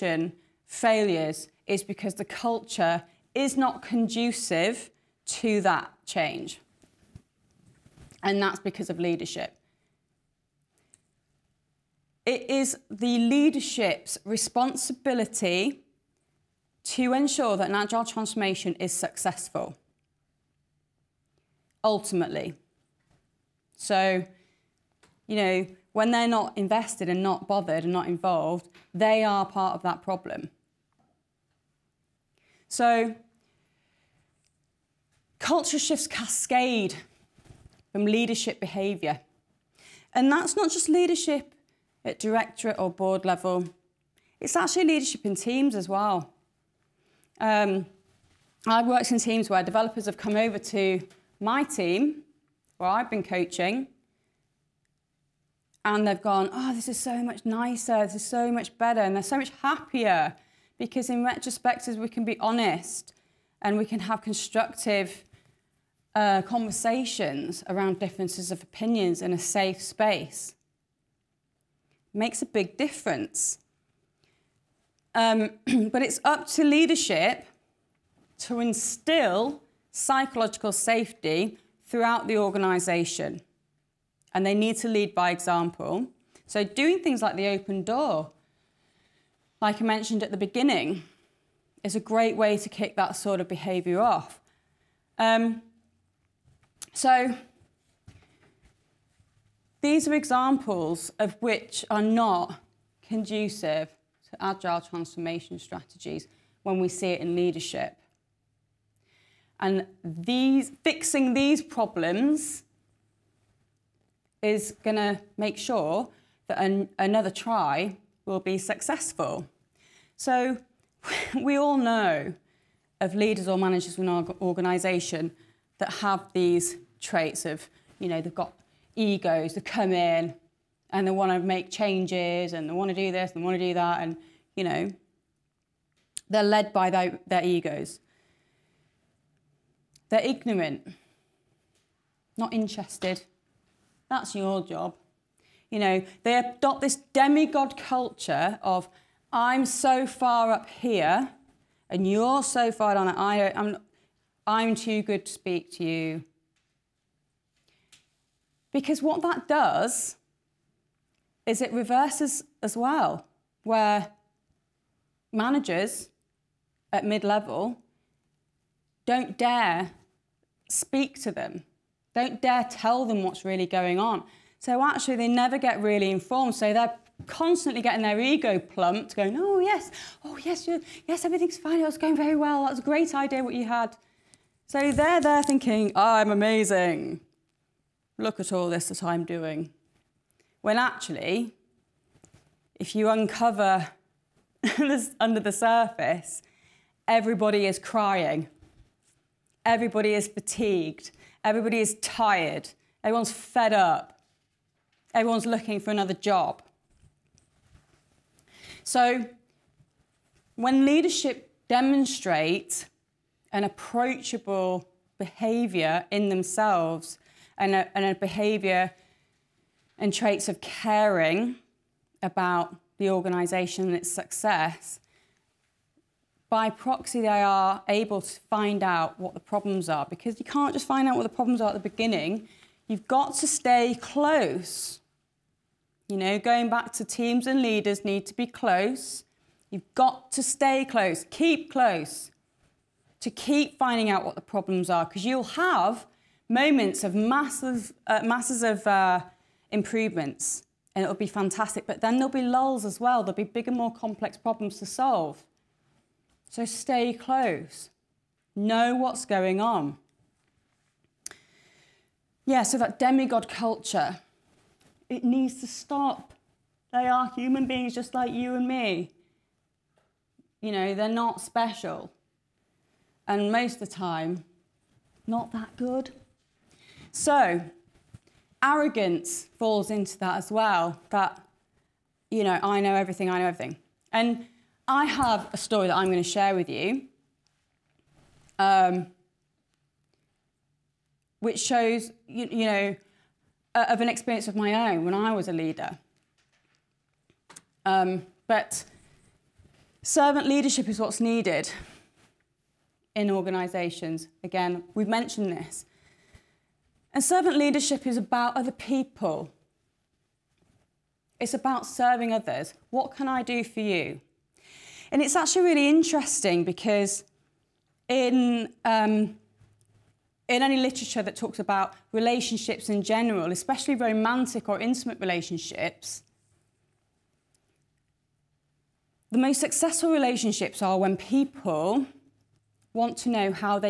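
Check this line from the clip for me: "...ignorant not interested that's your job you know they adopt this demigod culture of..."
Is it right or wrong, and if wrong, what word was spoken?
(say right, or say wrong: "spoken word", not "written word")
right.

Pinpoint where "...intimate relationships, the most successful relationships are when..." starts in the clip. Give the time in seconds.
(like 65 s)
324 s.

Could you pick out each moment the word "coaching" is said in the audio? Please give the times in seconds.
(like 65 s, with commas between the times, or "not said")
53 s.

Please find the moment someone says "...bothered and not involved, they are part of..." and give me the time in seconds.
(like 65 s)
27 s.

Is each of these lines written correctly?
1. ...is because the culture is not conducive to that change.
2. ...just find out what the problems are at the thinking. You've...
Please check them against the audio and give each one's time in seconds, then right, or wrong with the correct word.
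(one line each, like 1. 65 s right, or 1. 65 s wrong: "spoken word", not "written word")
1. 1 s right
2. 230 s wrong: "beginning", not "thinking".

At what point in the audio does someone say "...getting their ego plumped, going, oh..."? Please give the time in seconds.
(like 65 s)
177 s.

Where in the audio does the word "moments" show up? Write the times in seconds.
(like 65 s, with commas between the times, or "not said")
246 s.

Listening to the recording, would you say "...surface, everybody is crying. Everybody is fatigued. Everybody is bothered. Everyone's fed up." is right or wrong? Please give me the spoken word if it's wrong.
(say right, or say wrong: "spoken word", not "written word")
wrong: "tired", not "bothered".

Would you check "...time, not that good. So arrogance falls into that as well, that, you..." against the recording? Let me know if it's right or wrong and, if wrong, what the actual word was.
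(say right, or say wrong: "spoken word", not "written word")
right.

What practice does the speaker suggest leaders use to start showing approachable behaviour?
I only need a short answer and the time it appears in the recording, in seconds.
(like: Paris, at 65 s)
The open door, at 87 s.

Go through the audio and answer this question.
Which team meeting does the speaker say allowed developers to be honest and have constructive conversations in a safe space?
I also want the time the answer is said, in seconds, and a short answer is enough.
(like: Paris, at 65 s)
Retrospectives, at 61 s.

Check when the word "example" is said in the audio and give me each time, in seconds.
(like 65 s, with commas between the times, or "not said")
85 s, 100 s.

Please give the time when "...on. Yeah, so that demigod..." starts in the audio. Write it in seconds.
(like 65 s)
259 s.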